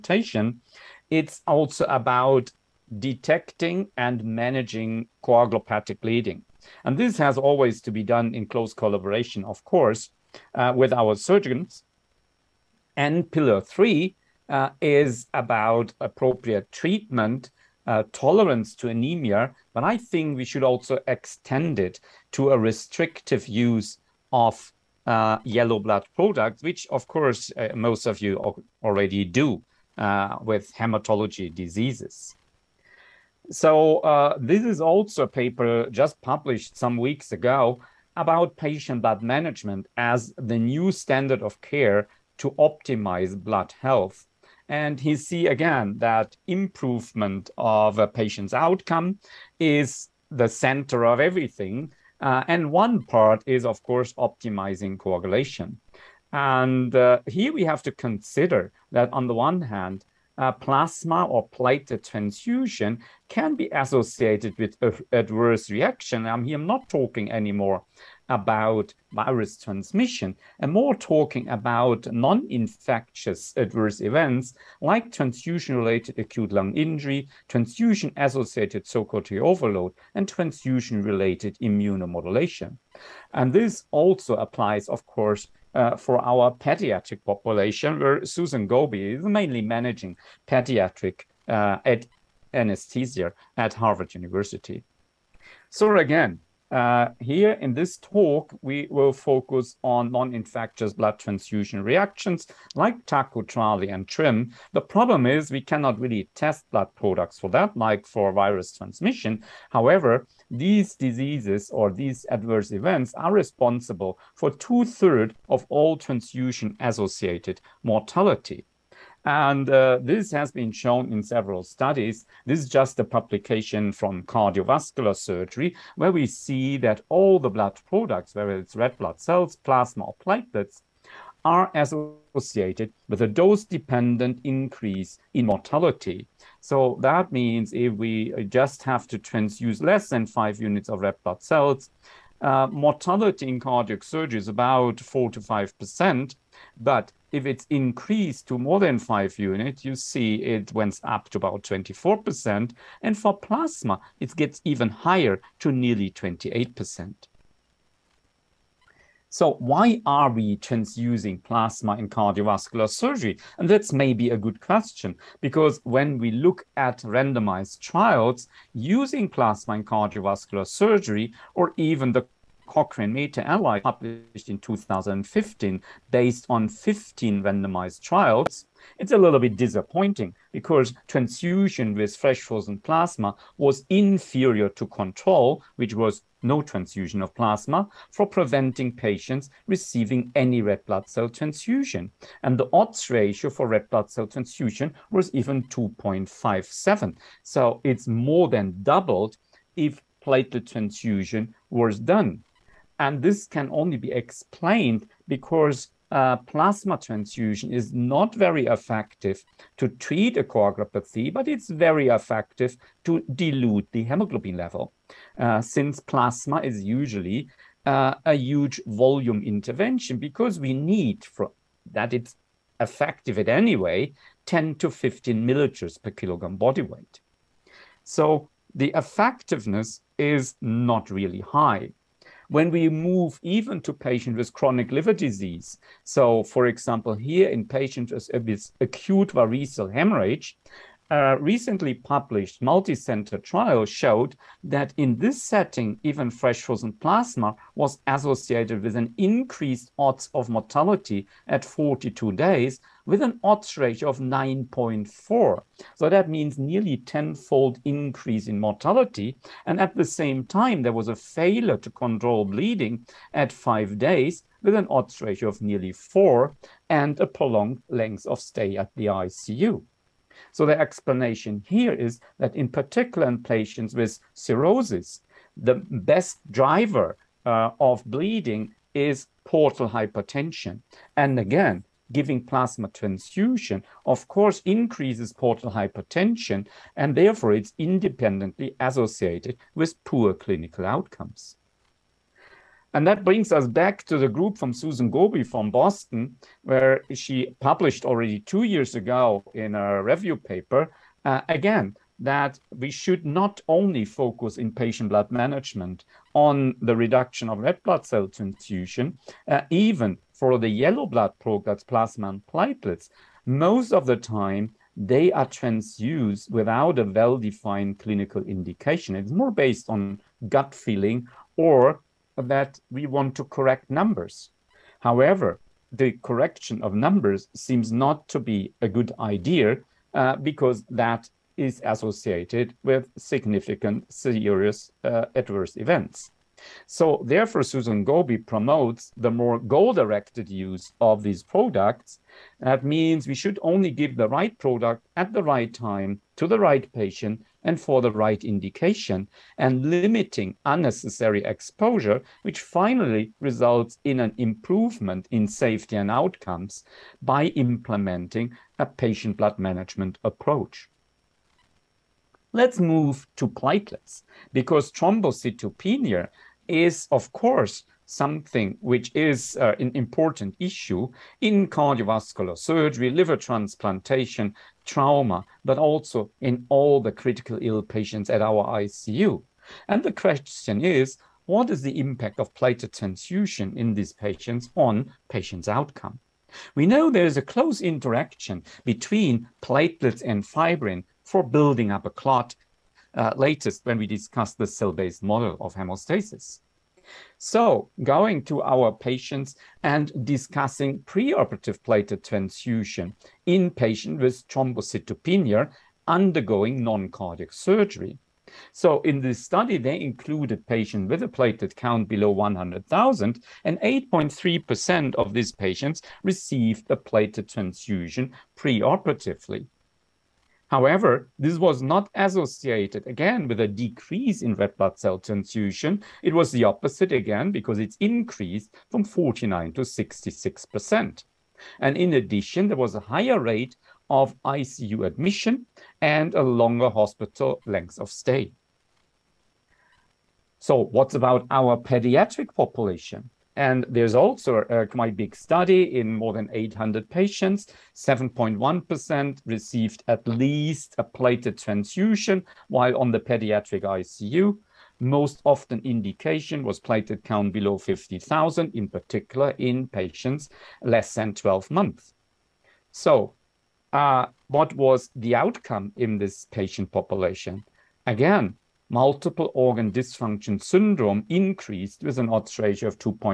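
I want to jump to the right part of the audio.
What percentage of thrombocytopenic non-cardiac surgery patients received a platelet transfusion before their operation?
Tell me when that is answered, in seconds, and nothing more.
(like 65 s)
413 s.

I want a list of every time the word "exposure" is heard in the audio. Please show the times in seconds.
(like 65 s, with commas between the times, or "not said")
351 s.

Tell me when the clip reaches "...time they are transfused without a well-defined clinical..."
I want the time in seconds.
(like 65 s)
314 s.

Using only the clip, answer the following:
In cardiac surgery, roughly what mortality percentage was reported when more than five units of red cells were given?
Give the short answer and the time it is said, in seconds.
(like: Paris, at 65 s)
24%, at 151 s.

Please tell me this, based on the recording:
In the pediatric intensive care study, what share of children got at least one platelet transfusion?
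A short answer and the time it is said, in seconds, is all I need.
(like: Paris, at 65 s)
7.1%, at 447 s.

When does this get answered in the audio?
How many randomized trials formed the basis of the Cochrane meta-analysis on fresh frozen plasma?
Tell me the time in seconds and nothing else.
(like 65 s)
176 s.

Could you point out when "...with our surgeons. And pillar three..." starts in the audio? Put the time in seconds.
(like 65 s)
10 s.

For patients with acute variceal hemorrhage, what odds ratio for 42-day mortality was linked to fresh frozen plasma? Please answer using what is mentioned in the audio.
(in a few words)
9.4.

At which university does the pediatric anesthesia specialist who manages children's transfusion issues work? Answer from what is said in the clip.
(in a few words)
Harvard University.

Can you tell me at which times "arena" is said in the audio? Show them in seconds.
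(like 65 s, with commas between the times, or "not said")
not said.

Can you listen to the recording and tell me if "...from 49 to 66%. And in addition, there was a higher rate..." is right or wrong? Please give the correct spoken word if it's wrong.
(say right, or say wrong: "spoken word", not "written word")
right.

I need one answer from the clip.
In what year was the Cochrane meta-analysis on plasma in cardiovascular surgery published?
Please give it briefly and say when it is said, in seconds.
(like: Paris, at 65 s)
2015, at 174 s.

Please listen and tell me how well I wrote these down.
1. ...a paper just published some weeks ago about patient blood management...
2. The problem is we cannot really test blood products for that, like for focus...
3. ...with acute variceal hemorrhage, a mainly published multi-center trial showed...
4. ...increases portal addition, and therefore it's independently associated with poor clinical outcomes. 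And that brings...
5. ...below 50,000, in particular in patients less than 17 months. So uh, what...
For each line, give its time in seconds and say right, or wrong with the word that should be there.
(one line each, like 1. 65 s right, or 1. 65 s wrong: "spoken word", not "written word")
1. 35 s right
2. 104 s wrong: "virus", not "focus"
3. 238 s wrong: "recently", not "mainly"
4. 284 s wrong: "hypertension", not "addition"
5. 457 s wrong: "12", not "17".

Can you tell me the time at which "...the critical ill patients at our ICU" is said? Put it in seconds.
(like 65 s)
377 s.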